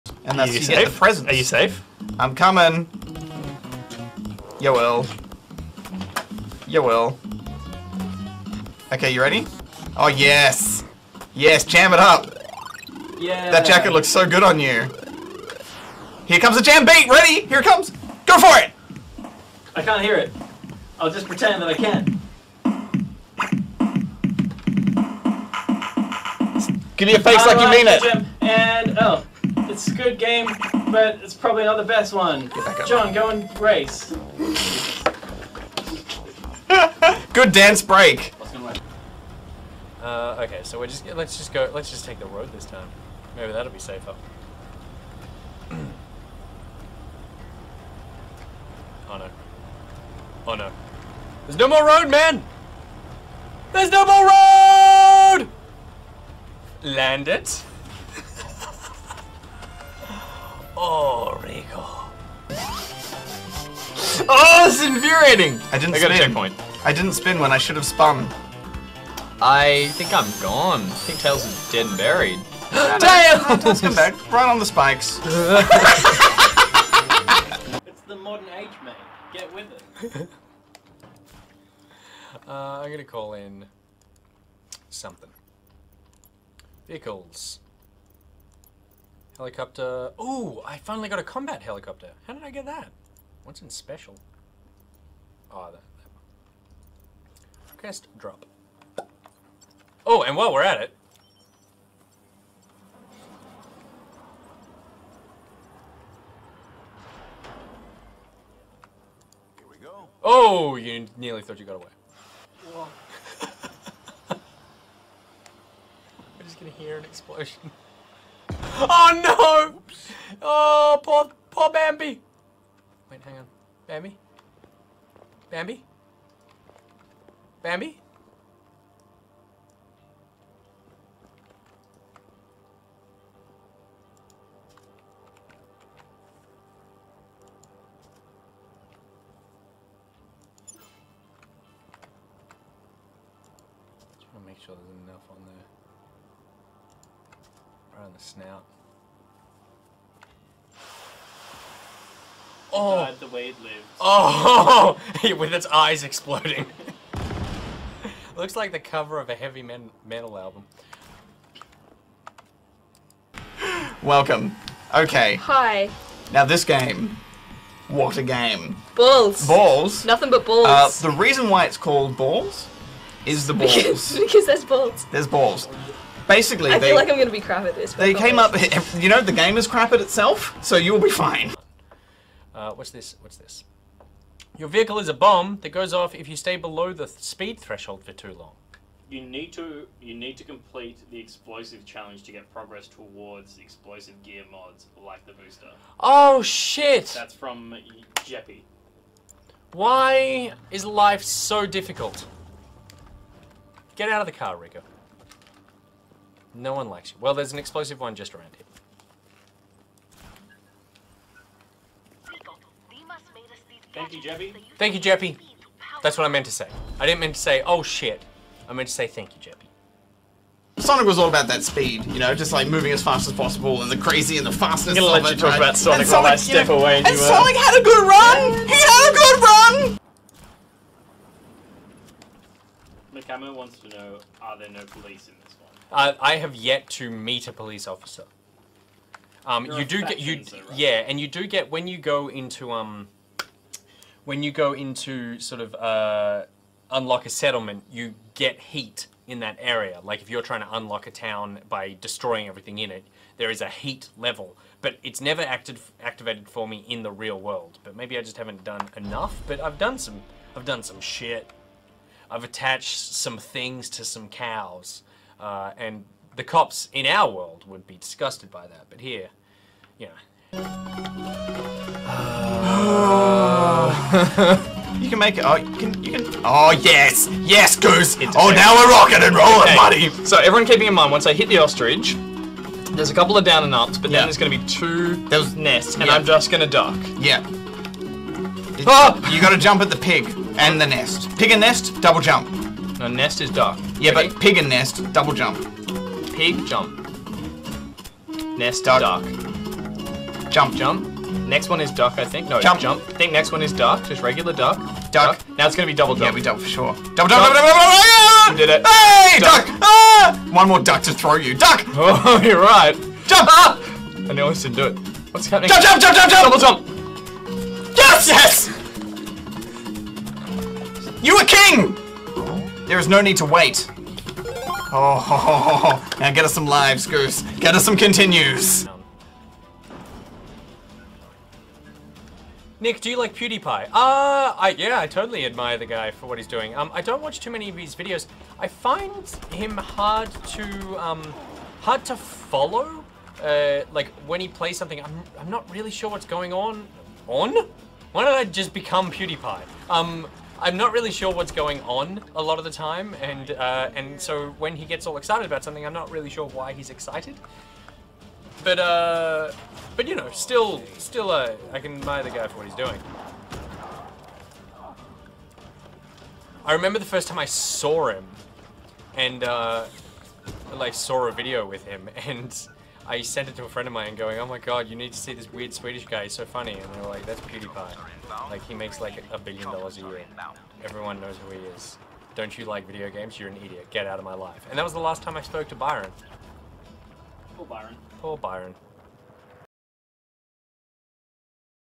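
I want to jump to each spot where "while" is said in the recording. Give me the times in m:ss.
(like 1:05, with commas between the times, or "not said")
1:40, 3:46.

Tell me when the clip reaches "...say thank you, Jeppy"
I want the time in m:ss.
3:38.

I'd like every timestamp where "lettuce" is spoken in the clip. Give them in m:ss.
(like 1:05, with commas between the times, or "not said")
not said.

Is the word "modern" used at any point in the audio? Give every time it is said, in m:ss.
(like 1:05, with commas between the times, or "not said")
1:18.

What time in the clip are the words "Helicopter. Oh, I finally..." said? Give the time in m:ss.
1:29.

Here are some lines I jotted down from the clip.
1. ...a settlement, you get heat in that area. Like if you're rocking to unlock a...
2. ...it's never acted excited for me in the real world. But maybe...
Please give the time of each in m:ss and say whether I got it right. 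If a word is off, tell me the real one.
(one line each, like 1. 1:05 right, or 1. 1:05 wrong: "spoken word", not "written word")
1. 4:07 wrong: "trying", not "rocking"
2. 4:15 wrong: "activated", not "excited".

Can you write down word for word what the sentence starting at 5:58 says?
But uh, but you know, still, still, uh, I can admire the guy for what he's doing.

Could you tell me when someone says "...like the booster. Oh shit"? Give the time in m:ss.
3:15.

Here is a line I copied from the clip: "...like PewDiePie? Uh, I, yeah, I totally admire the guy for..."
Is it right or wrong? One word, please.
right.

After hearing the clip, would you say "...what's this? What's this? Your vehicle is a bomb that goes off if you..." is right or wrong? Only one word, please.
right.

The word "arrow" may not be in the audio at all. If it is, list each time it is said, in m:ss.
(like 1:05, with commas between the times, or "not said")
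not said.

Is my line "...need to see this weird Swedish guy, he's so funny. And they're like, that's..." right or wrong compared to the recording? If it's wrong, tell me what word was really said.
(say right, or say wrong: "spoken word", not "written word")
right.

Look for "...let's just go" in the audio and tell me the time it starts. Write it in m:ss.
0:41.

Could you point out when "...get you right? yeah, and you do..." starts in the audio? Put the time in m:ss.
4:00.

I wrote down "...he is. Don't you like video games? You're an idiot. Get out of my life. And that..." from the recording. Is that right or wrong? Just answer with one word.
right.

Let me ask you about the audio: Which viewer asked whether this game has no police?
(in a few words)
Mikamo.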